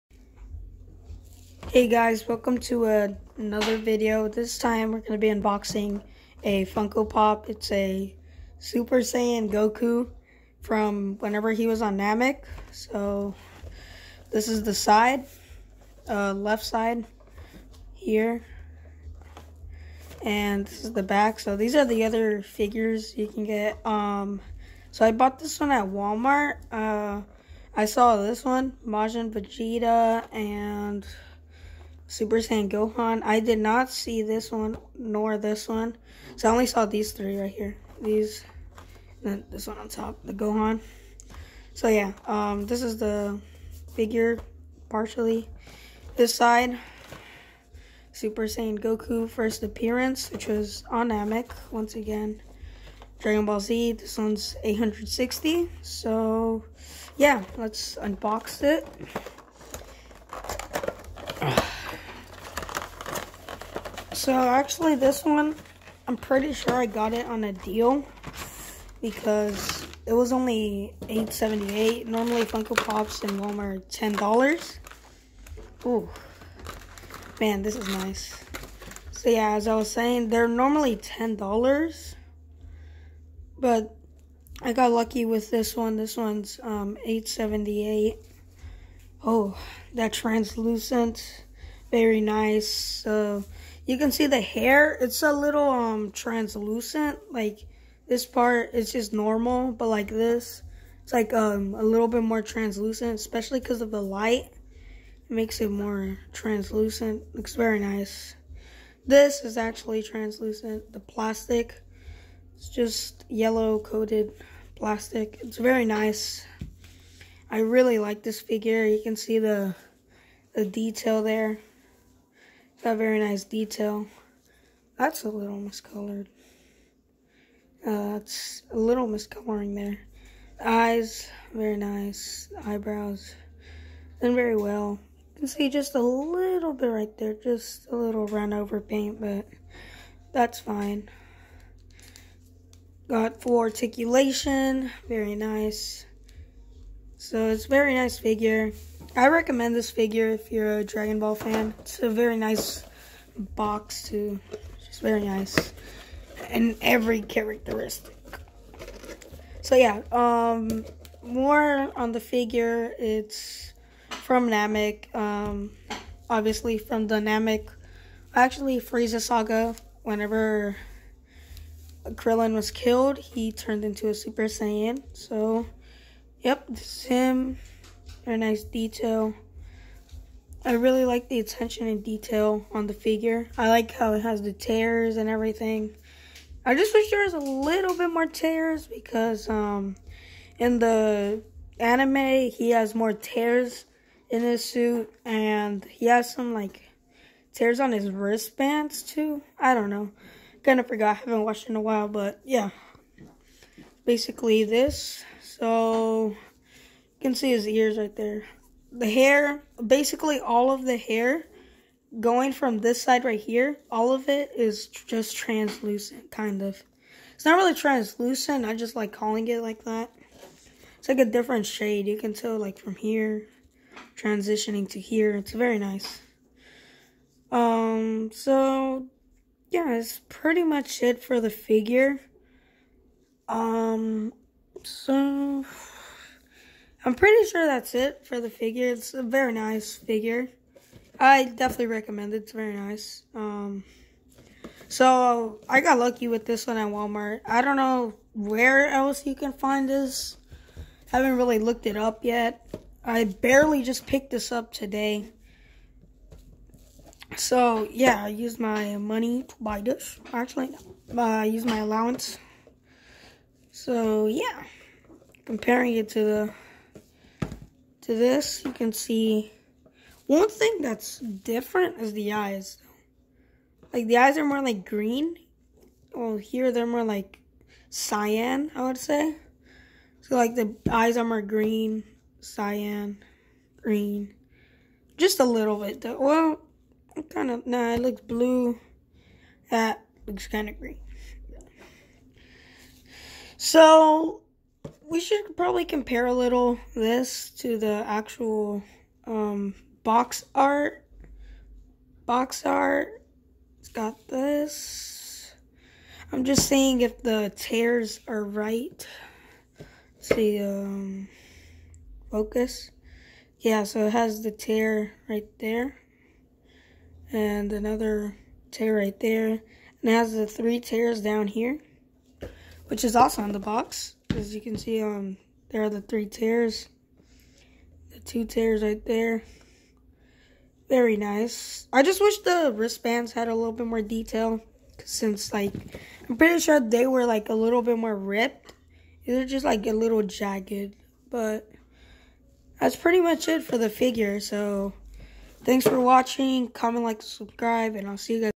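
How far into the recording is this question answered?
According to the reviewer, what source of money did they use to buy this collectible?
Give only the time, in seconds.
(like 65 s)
261 s.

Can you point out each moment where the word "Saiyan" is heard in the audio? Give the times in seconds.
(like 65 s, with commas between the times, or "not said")
8 s, 32 s, 48 s, 174 s.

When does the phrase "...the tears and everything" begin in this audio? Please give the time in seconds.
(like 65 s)
184 s.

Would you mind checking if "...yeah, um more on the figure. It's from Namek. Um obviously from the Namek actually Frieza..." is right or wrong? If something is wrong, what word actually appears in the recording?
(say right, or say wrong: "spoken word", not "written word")
right.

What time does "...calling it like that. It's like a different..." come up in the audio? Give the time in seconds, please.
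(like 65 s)
219 s.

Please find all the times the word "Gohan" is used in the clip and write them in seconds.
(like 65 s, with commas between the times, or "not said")
32 s, 40 s.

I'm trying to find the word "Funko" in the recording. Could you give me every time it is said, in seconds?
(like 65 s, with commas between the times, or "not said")
6 s, 72 s.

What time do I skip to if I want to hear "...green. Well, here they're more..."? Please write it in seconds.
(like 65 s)
274 s.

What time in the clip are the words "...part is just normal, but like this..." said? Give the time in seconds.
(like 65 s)
98 s.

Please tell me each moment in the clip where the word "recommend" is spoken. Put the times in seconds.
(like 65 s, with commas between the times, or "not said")
149 s, 241 s.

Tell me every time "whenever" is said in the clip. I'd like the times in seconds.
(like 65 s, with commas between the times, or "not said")
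11 s, 170 s.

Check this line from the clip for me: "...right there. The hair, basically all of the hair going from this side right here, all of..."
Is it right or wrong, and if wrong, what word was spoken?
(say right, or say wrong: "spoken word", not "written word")
right.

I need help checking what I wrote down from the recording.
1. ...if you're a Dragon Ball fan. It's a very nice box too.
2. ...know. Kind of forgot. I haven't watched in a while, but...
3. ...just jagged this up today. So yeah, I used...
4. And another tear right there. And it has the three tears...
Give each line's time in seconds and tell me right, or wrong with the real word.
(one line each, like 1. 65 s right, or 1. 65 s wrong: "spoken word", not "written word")
1. 150 s right
2. 199 s right
3. 253 s wrong: "picked", not "jagged"
4. 317 s right.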